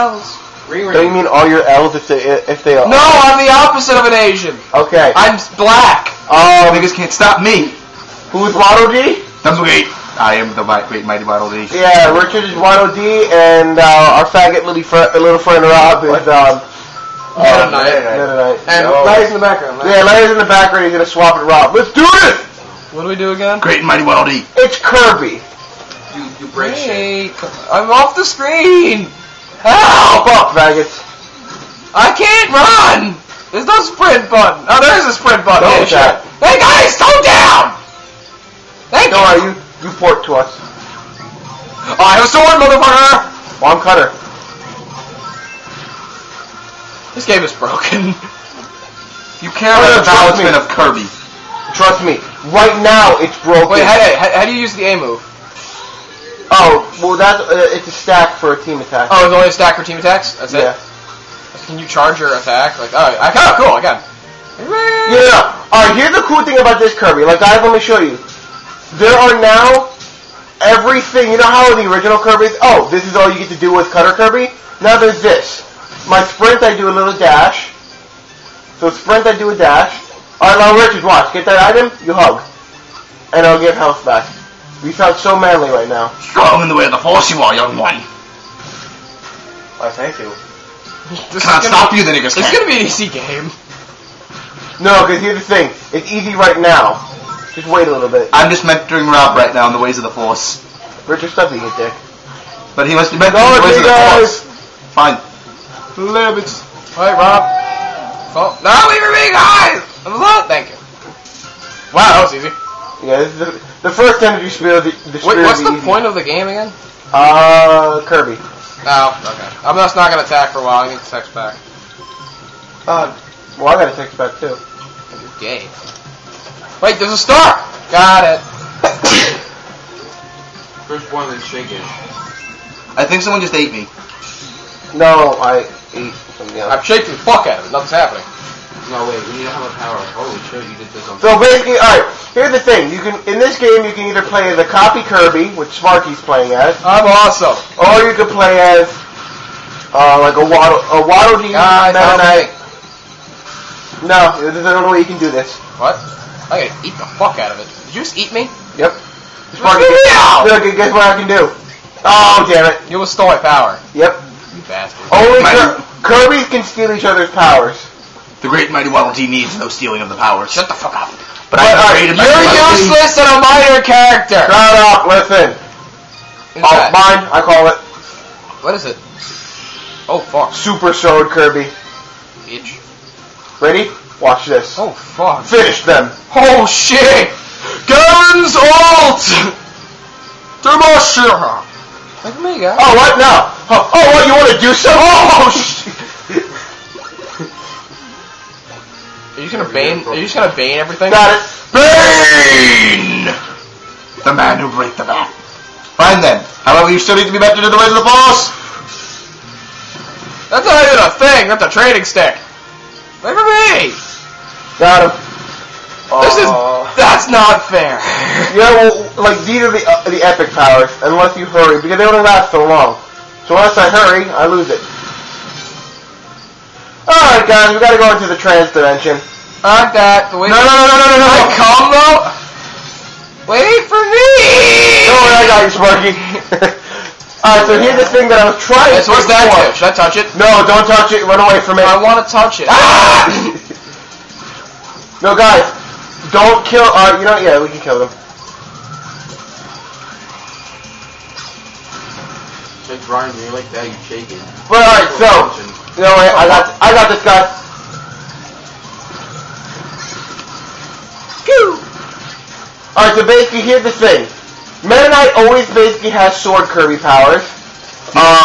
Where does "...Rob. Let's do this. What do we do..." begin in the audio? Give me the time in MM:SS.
00:21.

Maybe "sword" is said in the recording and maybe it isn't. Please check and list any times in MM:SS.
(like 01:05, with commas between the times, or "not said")
00:42, 03:00, 04:26.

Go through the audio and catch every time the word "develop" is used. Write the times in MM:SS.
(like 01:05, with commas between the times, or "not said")
not said.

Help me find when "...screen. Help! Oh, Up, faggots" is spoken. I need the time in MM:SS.
00:28.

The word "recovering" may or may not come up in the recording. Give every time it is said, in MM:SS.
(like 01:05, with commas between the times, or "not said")
not said.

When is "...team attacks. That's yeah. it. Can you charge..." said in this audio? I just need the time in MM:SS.
00:59.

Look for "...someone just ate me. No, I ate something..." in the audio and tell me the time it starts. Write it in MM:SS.
02:13.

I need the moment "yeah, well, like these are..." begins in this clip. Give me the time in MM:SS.
03:38.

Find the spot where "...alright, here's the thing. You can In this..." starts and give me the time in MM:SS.
02:21.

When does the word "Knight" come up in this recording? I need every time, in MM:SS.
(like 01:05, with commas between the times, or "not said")
02:31, 04:25.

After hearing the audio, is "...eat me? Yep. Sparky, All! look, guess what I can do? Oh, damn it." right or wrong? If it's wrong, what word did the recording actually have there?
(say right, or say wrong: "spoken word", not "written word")
wrong: "Meow", not "All".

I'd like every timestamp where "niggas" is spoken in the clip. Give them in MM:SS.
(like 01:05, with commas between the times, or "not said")
00:06, 01:32.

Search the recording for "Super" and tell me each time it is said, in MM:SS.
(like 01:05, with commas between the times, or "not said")
03:00.